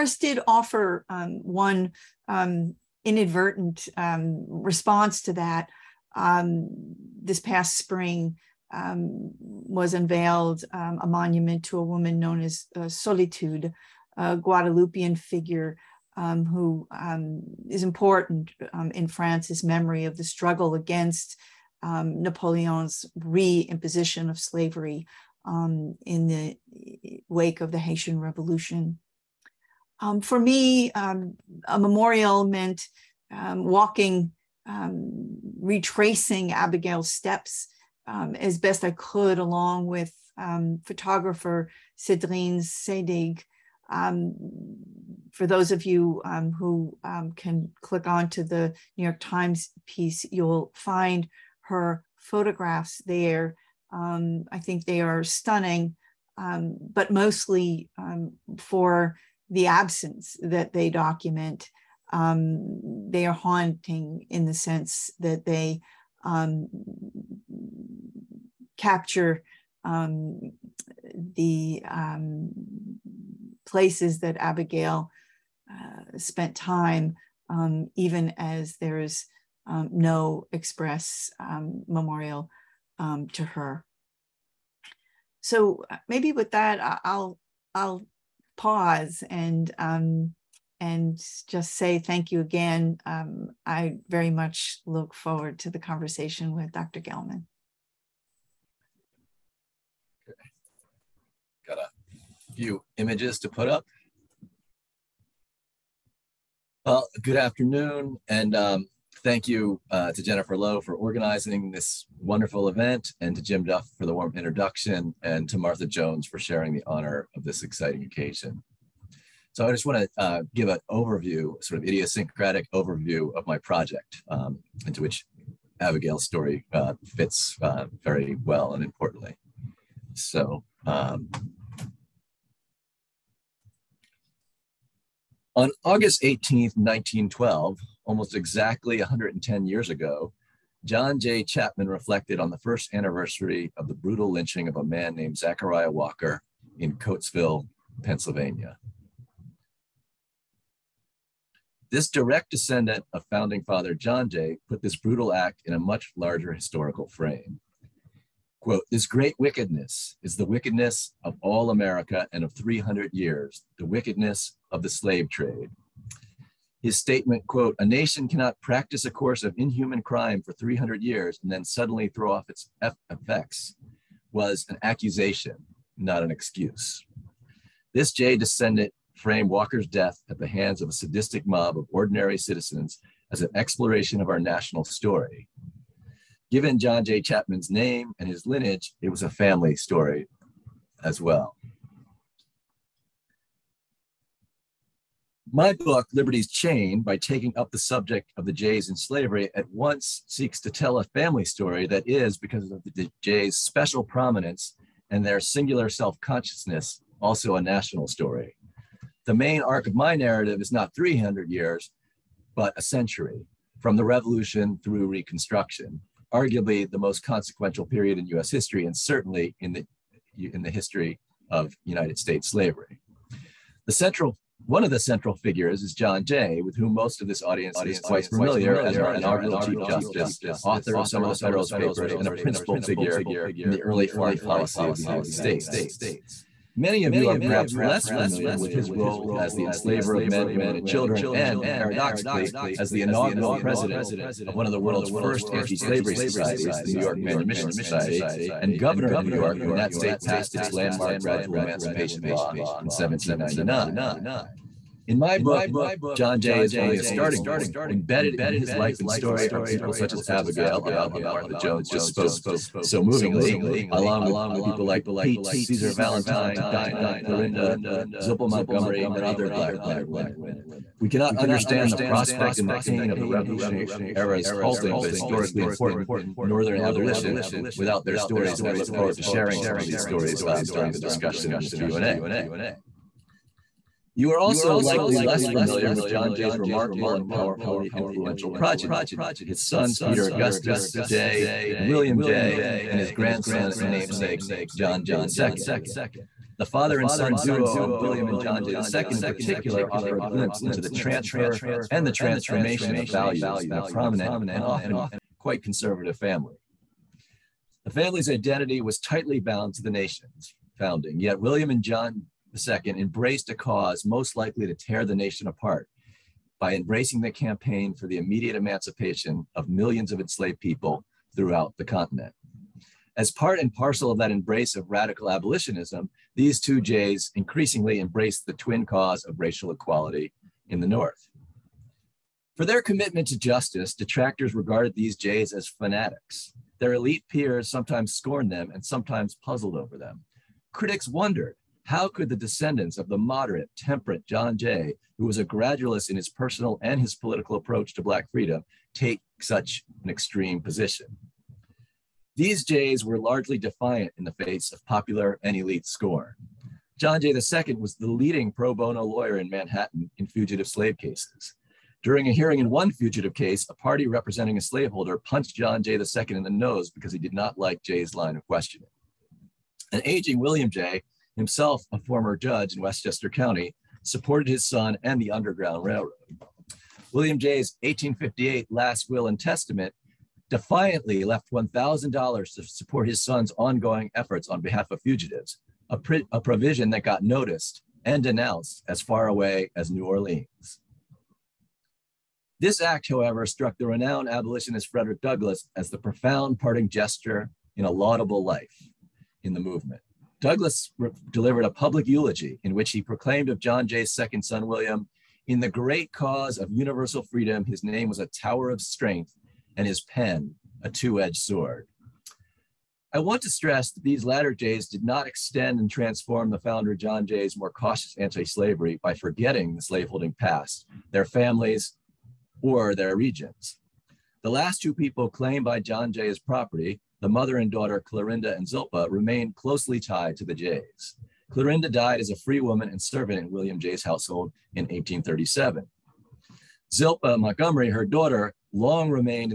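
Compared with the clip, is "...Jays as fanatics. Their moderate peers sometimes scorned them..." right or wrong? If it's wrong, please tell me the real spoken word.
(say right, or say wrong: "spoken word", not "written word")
wrong: "elite", not "moderate".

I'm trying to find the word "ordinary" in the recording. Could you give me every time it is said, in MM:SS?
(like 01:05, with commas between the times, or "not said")
03:01.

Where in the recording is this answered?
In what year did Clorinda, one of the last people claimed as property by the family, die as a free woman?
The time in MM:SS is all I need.
07:14.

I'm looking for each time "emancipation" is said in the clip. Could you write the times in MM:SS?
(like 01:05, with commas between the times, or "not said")
04:11, 05:18.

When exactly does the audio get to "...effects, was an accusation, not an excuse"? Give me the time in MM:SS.
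02:53.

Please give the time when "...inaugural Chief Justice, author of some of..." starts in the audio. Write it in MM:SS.
03:49.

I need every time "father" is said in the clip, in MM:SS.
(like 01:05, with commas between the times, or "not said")
02:33, 04:56.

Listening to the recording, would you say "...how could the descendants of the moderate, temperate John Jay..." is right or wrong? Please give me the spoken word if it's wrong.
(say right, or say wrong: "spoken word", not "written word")
right.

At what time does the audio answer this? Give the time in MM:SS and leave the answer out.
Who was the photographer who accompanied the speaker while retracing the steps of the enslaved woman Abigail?
00:41.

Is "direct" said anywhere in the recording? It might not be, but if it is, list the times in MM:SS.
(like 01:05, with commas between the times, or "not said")
02:32.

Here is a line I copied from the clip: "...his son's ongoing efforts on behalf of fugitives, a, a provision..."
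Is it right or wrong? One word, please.
right.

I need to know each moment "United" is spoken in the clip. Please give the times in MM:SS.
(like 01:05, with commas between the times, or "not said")
03:41, 03:55.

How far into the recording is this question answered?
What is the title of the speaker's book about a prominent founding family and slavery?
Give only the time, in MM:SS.
03:16.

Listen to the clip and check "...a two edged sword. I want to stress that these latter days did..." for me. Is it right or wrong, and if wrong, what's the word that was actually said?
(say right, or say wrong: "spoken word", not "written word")
right.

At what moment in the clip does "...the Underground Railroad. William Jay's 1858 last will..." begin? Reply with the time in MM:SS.
06:15.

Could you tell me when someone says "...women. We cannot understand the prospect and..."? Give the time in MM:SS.
04:30.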